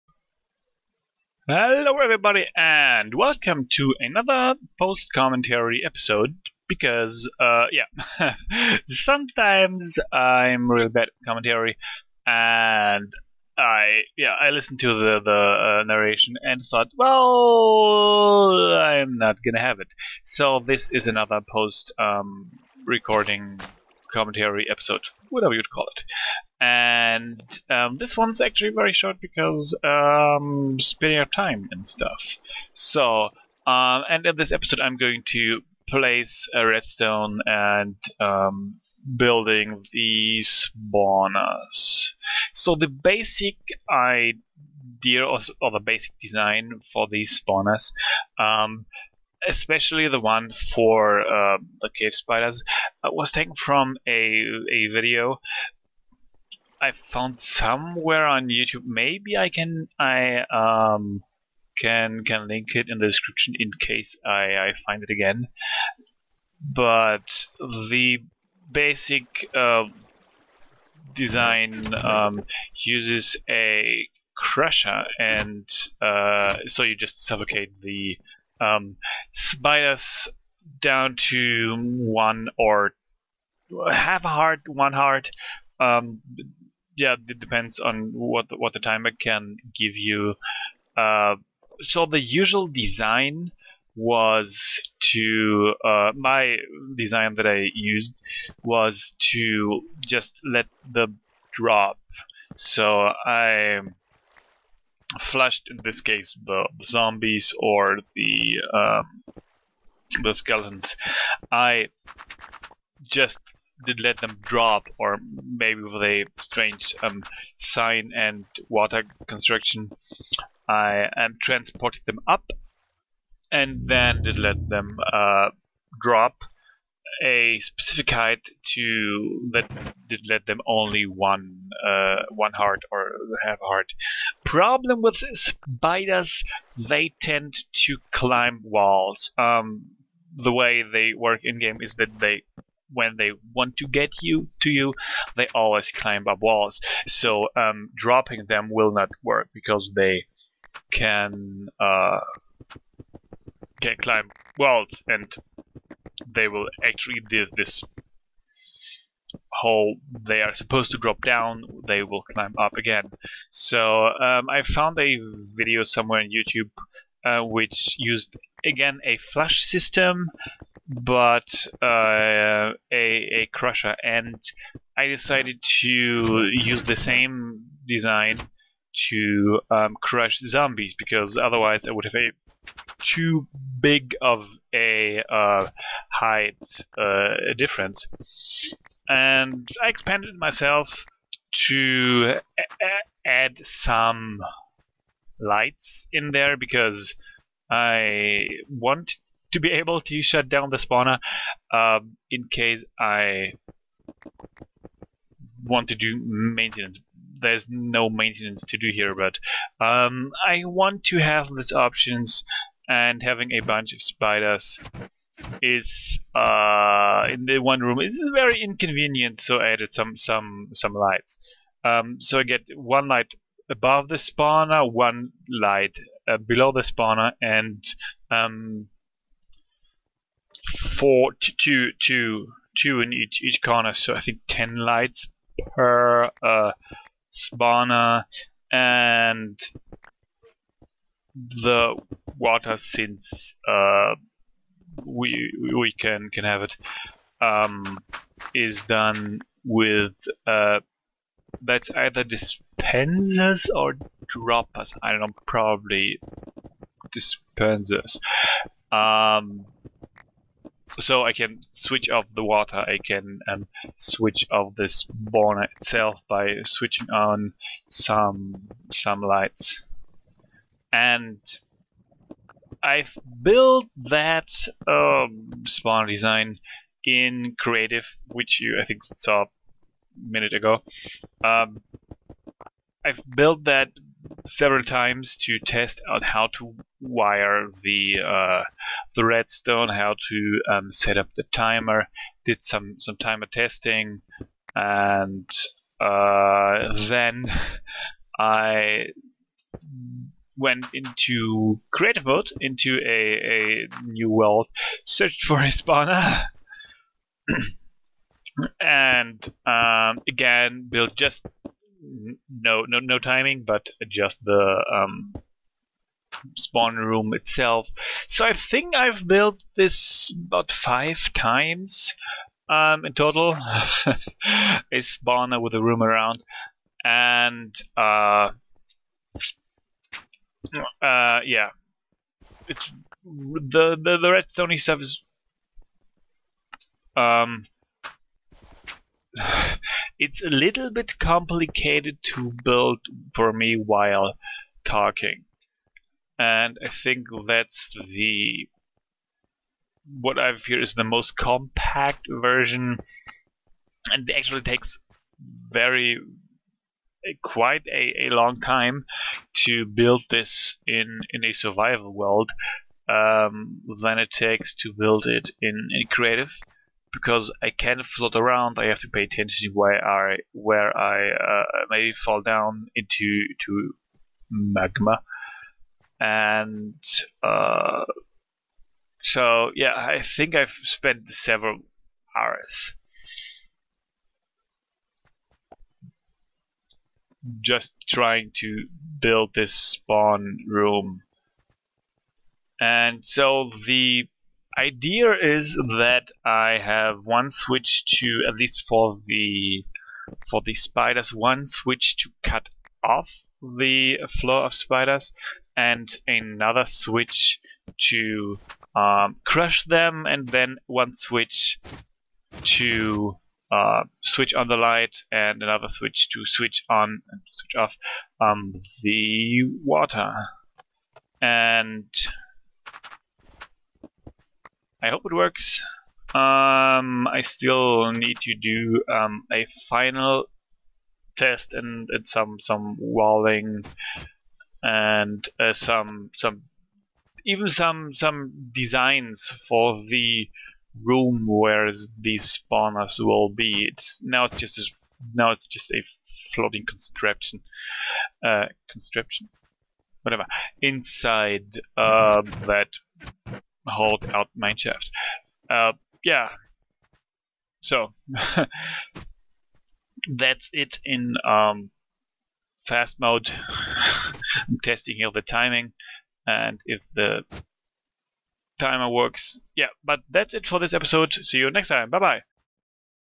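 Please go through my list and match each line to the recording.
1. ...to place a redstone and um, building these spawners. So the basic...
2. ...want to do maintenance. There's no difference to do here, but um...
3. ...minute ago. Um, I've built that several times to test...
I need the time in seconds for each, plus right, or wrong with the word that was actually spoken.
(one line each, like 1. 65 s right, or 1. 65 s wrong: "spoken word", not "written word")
1. 35 s right
2. 205 s wrong: "maintenance", not "difference"
3. 280 s right.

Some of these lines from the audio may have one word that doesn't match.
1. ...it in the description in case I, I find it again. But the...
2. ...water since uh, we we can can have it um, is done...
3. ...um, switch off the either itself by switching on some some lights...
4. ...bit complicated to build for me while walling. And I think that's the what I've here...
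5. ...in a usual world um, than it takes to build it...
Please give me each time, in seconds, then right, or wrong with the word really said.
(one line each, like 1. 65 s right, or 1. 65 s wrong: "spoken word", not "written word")
1. 62 s right
2. 242 s right
3. 263 s wrong: "spawner", not "either"
4. 340 s wrong: "talking", not "walling"
5. 361 s wrong: "survival", not "usual".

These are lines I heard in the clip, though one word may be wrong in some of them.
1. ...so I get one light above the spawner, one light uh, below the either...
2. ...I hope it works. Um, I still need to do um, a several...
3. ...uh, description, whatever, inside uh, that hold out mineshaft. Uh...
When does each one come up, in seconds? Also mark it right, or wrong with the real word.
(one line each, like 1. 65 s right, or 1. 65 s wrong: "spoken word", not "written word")
1. 222 s wrong: "spawner", not "either"
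2. 425 s wrong: "final", not "several"
3. 448 s wrong: "construction", not "description".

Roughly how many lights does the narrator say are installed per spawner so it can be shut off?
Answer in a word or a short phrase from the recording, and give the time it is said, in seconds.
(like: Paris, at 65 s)
10, at 234 s.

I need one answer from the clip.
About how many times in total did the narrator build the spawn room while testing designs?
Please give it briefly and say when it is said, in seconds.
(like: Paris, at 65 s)
5, at 320 s.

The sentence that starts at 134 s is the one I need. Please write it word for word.
Problem with spiders, they tend to climb walls.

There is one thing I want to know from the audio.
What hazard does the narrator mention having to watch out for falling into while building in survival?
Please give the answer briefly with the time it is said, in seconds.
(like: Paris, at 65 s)
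Magma, at 374 s.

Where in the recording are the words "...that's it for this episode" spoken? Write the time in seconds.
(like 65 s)
470 s.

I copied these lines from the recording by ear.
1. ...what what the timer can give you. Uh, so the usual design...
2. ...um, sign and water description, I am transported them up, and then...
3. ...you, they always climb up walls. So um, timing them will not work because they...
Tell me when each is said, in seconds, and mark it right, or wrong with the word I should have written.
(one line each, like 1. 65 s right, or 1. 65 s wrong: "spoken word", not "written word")
1. 88 s right
2. 117 s wrong: "construction", not "description"
3. 144 s wrong: "dropping", not "timing".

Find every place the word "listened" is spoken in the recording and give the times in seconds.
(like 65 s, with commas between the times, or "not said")
14 s.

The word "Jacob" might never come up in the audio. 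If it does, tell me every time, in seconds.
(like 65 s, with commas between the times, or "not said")
not said.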